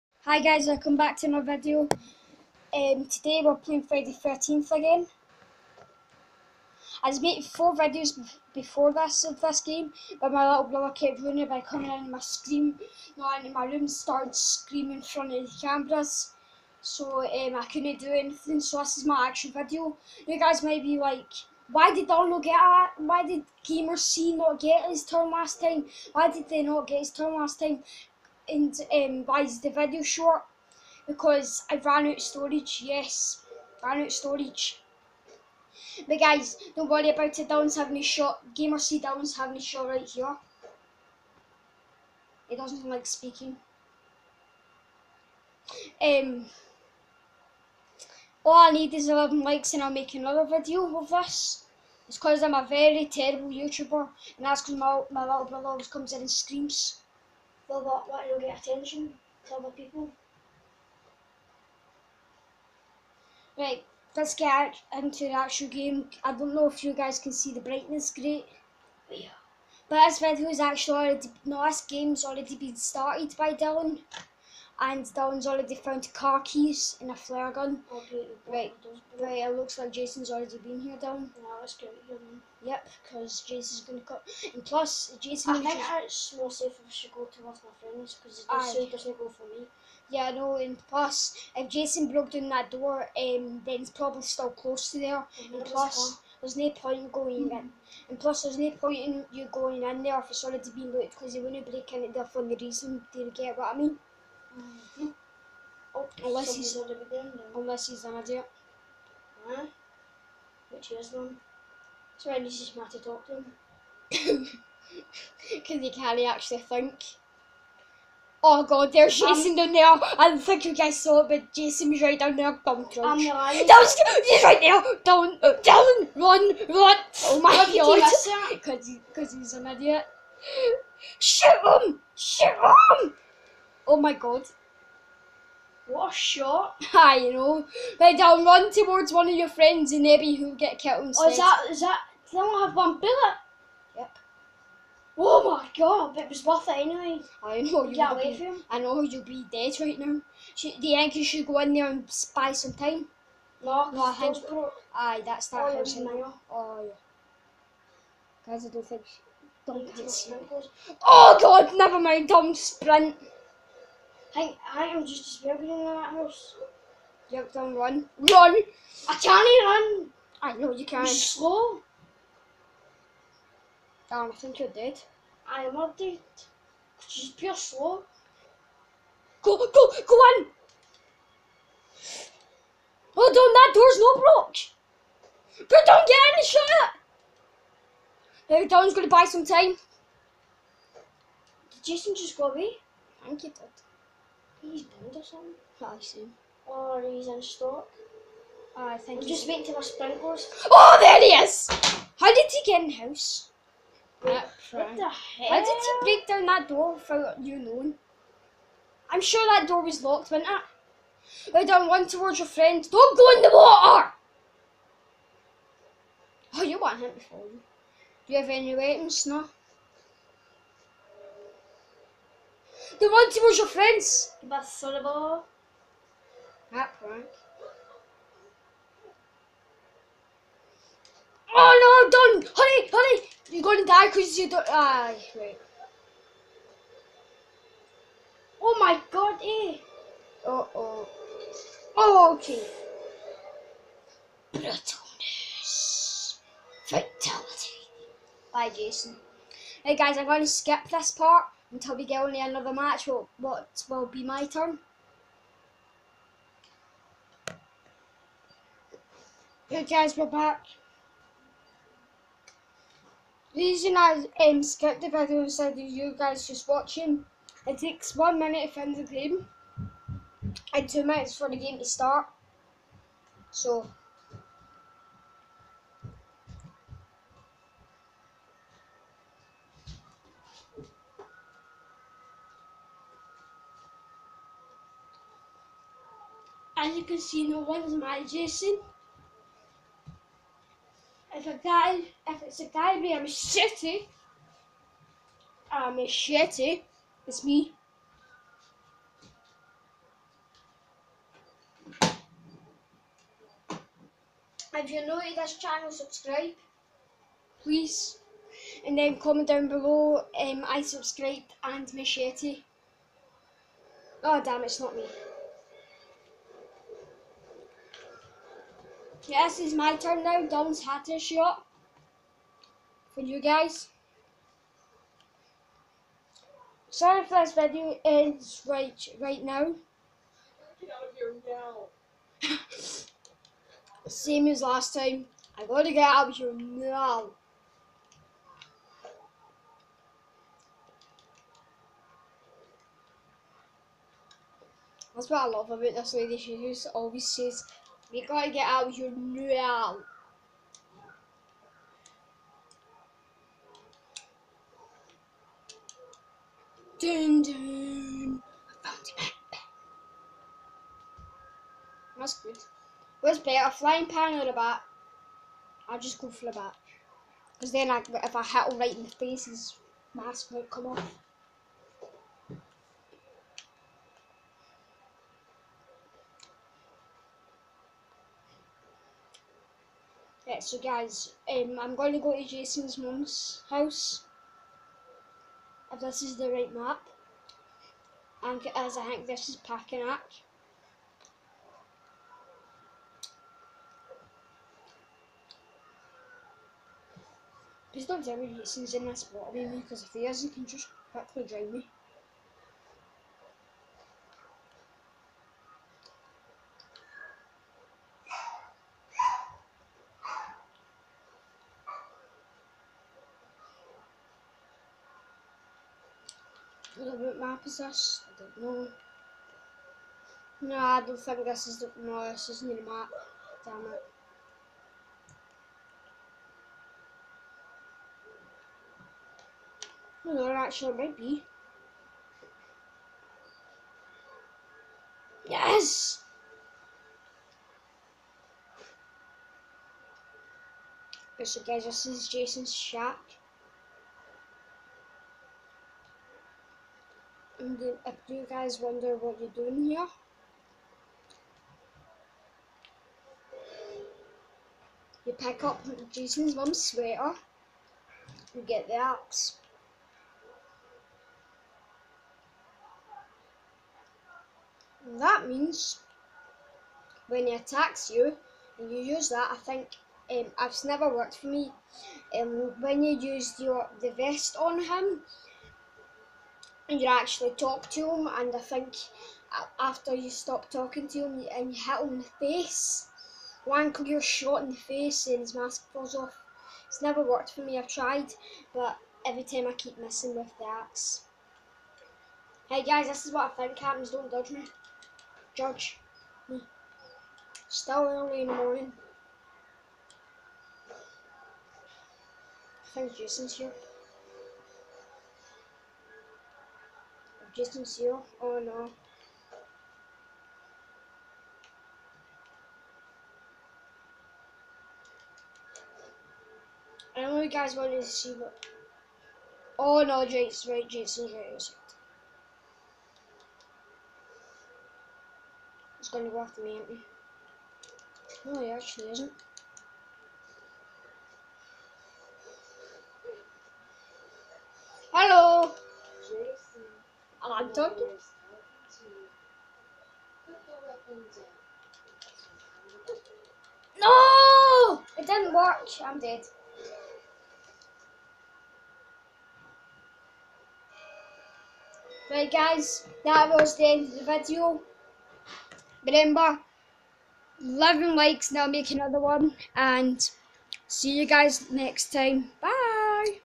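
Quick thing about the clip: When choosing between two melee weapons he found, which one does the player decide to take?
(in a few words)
The bat.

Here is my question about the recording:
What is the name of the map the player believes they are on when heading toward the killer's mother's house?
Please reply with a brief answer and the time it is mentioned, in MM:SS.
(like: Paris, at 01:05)
Packanack, at 06:29.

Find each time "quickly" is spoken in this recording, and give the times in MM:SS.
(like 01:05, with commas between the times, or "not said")
06:41.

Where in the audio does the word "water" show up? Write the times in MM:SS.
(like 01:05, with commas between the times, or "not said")
03:33, 06:39.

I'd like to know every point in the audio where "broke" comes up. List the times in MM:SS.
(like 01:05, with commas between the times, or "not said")
01:32.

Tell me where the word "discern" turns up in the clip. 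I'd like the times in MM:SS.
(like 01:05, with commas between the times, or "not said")
not said.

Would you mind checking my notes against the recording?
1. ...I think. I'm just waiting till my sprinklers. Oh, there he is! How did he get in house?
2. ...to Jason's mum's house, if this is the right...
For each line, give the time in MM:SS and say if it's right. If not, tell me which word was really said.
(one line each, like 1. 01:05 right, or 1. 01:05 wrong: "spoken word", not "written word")
1. 03:18 right
2. 06:22 right.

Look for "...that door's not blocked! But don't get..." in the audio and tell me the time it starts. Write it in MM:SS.
03:03.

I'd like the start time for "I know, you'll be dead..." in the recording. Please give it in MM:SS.
02:28.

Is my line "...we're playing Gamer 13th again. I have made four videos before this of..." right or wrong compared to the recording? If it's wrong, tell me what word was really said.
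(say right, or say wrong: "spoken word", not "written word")
wrong: "Friday", not "Gamer".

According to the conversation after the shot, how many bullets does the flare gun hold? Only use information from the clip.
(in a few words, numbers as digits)
1.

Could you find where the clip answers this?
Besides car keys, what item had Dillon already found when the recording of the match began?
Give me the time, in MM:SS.
01:17.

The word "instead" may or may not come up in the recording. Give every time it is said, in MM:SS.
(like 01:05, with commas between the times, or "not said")
02:21, 04:25.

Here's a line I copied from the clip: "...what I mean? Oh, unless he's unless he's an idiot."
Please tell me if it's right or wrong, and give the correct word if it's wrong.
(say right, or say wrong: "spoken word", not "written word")
right.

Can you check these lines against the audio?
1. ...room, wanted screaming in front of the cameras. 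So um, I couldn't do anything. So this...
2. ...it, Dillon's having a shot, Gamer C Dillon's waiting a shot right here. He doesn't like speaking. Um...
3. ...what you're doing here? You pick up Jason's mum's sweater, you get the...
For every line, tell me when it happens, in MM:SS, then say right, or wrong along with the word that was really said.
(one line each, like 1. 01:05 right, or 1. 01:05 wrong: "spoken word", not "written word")
1. 00:13 wrong: "started", not "wanted"
2. 00:37 wrong: "having", not "waiting"
3. 07:29 right.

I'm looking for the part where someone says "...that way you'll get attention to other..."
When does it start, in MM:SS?
00:58.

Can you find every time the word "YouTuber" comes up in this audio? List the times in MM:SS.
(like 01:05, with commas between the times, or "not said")
00:53.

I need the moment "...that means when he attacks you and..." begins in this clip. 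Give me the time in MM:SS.
07:45.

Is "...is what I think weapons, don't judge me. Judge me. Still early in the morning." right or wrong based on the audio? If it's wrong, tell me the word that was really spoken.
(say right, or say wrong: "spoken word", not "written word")
wrong: "happens", not "weapons".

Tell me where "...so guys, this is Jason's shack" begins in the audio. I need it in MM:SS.
07:21.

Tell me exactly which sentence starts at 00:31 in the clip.
Because I ran out storage, yes, ran out storage.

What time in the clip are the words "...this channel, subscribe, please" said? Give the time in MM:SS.
05:05.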